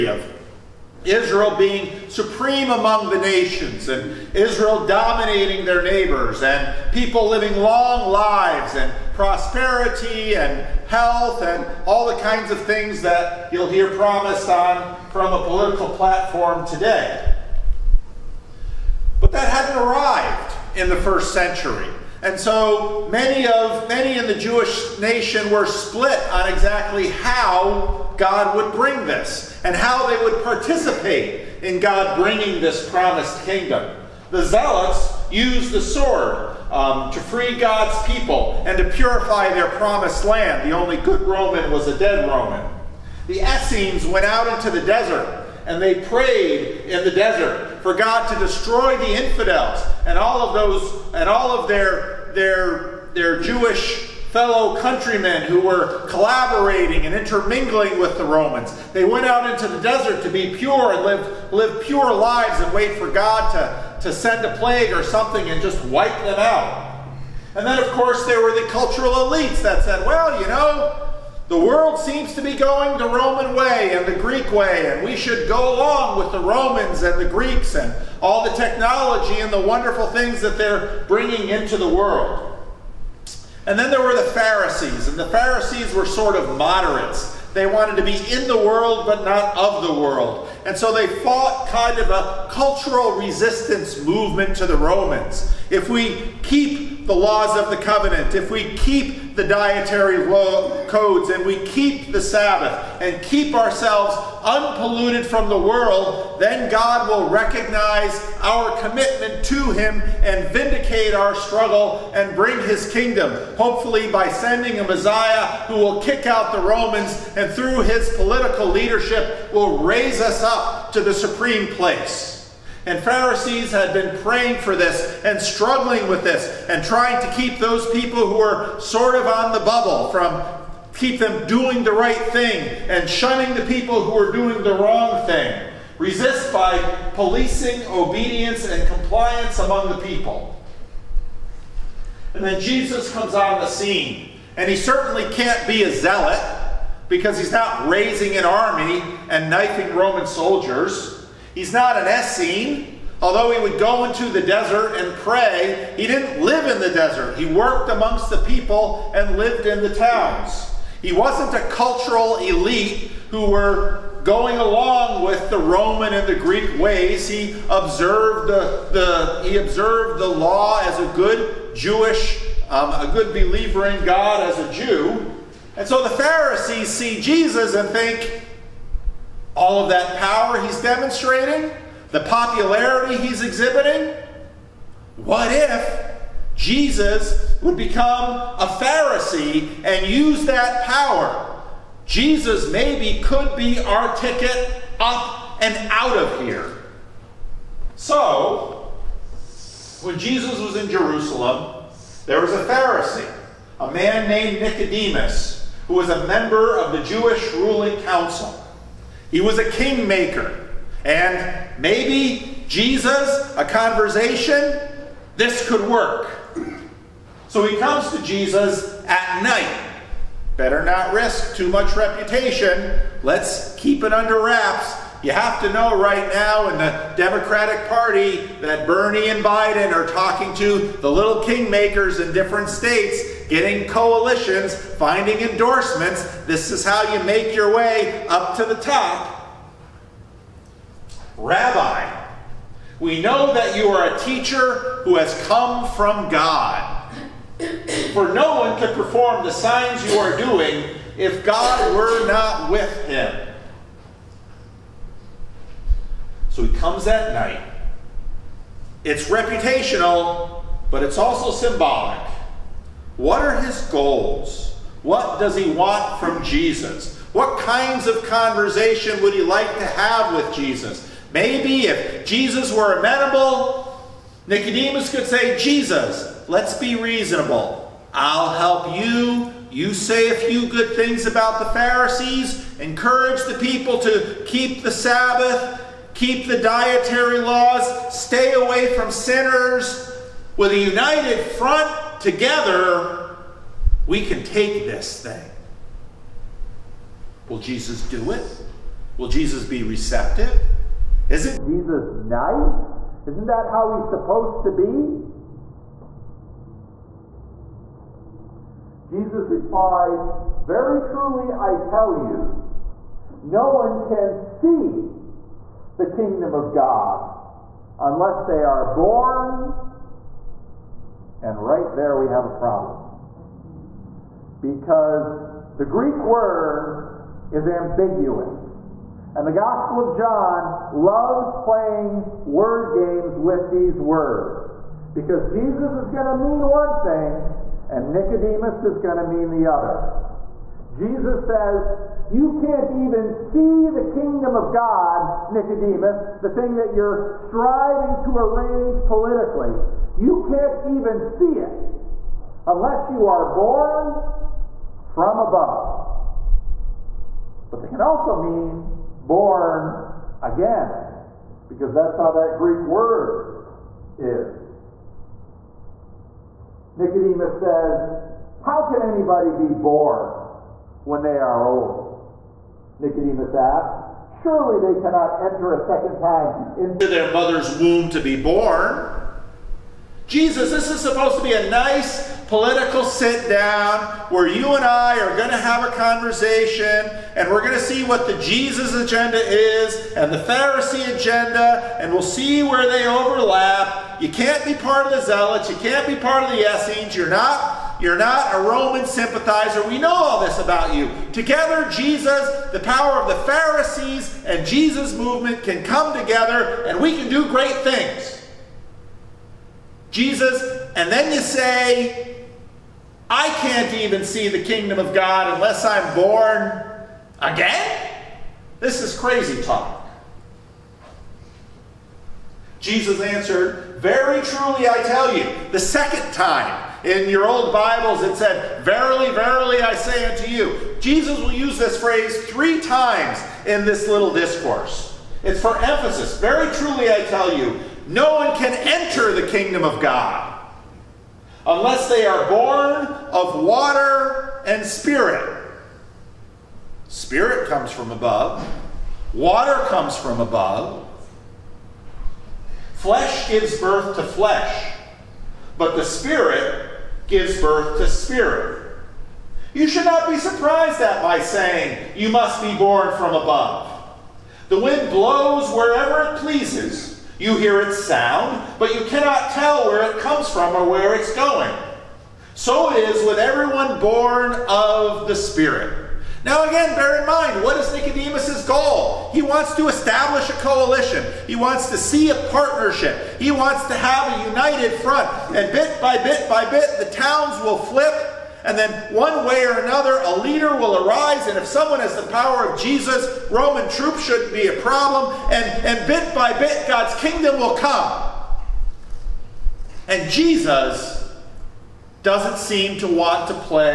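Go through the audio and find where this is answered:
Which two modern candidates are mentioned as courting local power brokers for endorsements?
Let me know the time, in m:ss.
3:48.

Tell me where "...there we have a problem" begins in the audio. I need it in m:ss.
5:21.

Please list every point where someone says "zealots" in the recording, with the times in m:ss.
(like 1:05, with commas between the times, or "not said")
0:34, 2:25, 6:35.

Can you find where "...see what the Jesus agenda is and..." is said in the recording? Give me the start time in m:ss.
6:27.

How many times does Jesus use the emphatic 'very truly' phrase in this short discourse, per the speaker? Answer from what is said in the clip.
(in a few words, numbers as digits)
3.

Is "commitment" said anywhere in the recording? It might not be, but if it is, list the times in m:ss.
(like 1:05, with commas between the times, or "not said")
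1:48.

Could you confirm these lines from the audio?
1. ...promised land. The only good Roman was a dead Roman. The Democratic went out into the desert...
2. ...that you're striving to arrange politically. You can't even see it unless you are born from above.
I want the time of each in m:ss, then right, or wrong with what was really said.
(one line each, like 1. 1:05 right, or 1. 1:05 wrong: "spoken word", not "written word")
1. 0:39 wrong: "Essenes", not "Democratic"
2. 5:46 right.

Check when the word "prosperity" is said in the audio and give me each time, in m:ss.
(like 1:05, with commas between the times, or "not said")
0:09.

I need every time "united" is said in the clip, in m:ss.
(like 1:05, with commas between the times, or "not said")
4:50, 8:04.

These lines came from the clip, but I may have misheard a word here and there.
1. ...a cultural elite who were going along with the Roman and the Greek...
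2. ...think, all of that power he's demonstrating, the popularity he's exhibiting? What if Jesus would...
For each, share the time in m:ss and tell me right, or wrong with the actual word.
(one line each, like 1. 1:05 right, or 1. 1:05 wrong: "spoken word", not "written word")
1. 2:41 right
2. 2:57 right.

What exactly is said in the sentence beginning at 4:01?
Rabbi, we know that you are a teacher who has come from God.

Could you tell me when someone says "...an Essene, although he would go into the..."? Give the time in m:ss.
2:31.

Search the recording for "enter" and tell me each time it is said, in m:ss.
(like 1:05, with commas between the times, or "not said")
6:15, 7:18.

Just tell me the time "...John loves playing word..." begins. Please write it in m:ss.
5:30.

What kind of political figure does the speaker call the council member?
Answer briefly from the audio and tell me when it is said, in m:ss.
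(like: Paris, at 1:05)
A kingmaker, at 3:29.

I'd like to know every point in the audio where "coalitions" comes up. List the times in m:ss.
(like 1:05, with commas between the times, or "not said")
3:53, 8:00.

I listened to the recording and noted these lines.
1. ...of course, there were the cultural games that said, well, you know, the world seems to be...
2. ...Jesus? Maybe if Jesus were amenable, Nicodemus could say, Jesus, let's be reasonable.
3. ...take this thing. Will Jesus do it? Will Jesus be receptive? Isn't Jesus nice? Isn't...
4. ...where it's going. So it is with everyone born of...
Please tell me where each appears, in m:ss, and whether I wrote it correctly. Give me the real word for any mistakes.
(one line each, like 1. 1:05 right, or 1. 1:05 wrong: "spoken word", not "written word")
1. 1:07 wrong: "elites", not "games"
2. 4:30 right
3. 4:54 right
4. 7:50 right.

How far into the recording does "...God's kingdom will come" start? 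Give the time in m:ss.
8:16.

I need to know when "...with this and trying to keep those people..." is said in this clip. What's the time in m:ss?
2:06.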